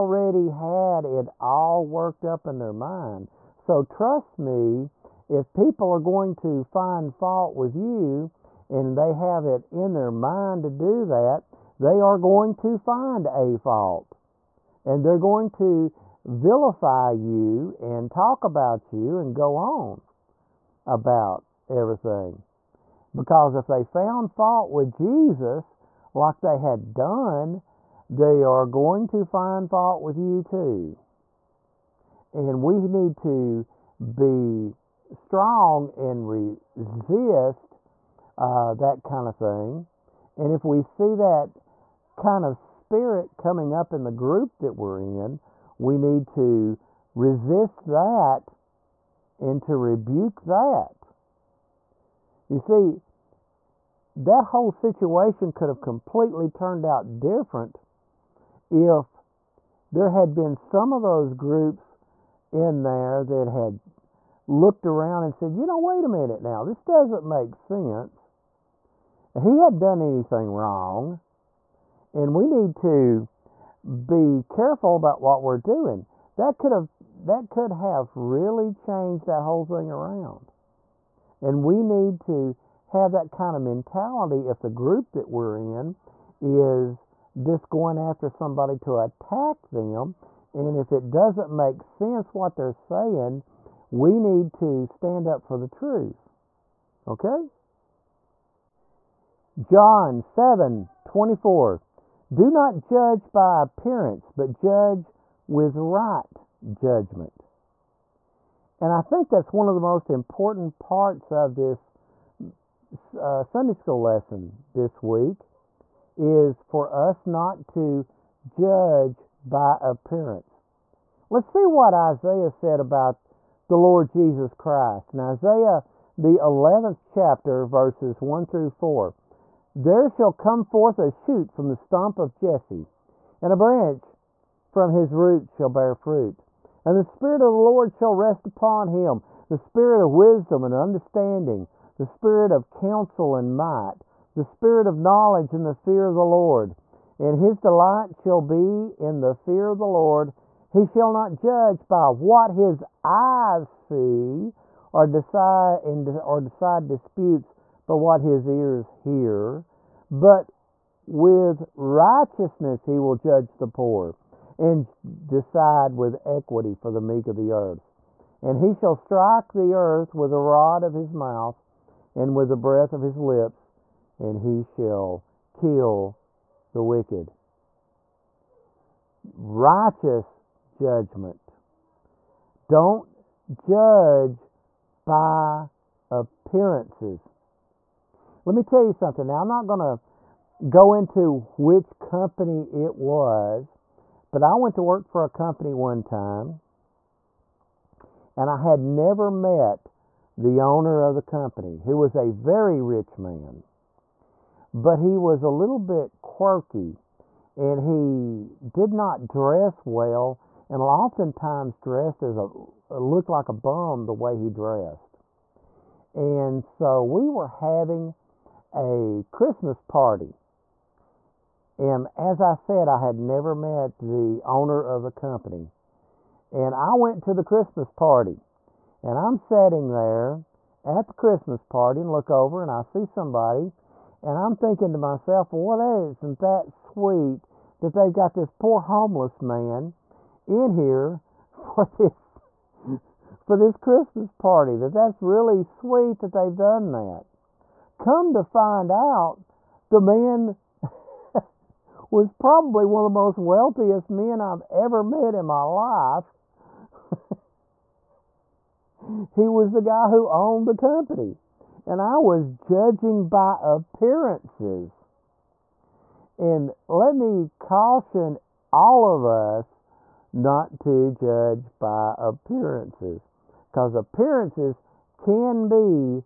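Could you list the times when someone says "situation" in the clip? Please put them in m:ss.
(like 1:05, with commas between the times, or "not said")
0:54.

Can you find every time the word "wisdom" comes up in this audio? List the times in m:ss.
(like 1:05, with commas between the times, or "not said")
2:20.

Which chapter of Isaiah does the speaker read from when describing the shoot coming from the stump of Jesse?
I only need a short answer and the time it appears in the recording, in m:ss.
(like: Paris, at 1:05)
11th chapter, at 2:06.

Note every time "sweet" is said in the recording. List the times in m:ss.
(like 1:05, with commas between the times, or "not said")
3:56, 4:05.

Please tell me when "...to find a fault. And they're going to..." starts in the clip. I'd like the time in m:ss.
0:12.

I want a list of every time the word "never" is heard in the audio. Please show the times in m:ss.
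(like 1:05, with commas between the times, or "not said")
3:18, 3:43.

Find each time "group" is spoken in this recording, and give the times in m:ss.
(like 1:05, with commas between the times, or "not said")
0:44, 1:01, 1:24.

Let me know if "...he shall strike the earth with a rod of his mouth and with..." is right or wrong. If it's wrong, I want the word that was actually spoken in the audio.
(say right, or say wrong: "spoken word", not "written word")
right.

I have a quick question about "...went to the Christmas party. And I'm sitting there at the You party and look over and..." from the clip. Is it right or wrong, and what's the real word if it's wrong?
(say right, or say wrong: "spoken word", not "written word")
wrong: "Christmas", not "You".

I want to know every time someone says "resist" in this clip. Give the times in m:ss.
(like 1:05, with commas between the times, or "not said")
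0:36, 0:47.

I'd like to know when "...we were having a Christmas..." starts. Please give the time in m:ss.
3:37.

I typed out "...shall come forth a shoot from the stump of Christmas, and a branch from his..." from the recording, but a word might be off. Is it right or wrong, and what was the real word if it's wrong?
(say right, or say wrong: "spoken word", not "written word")
wrong: "Jesse", not "Christmas".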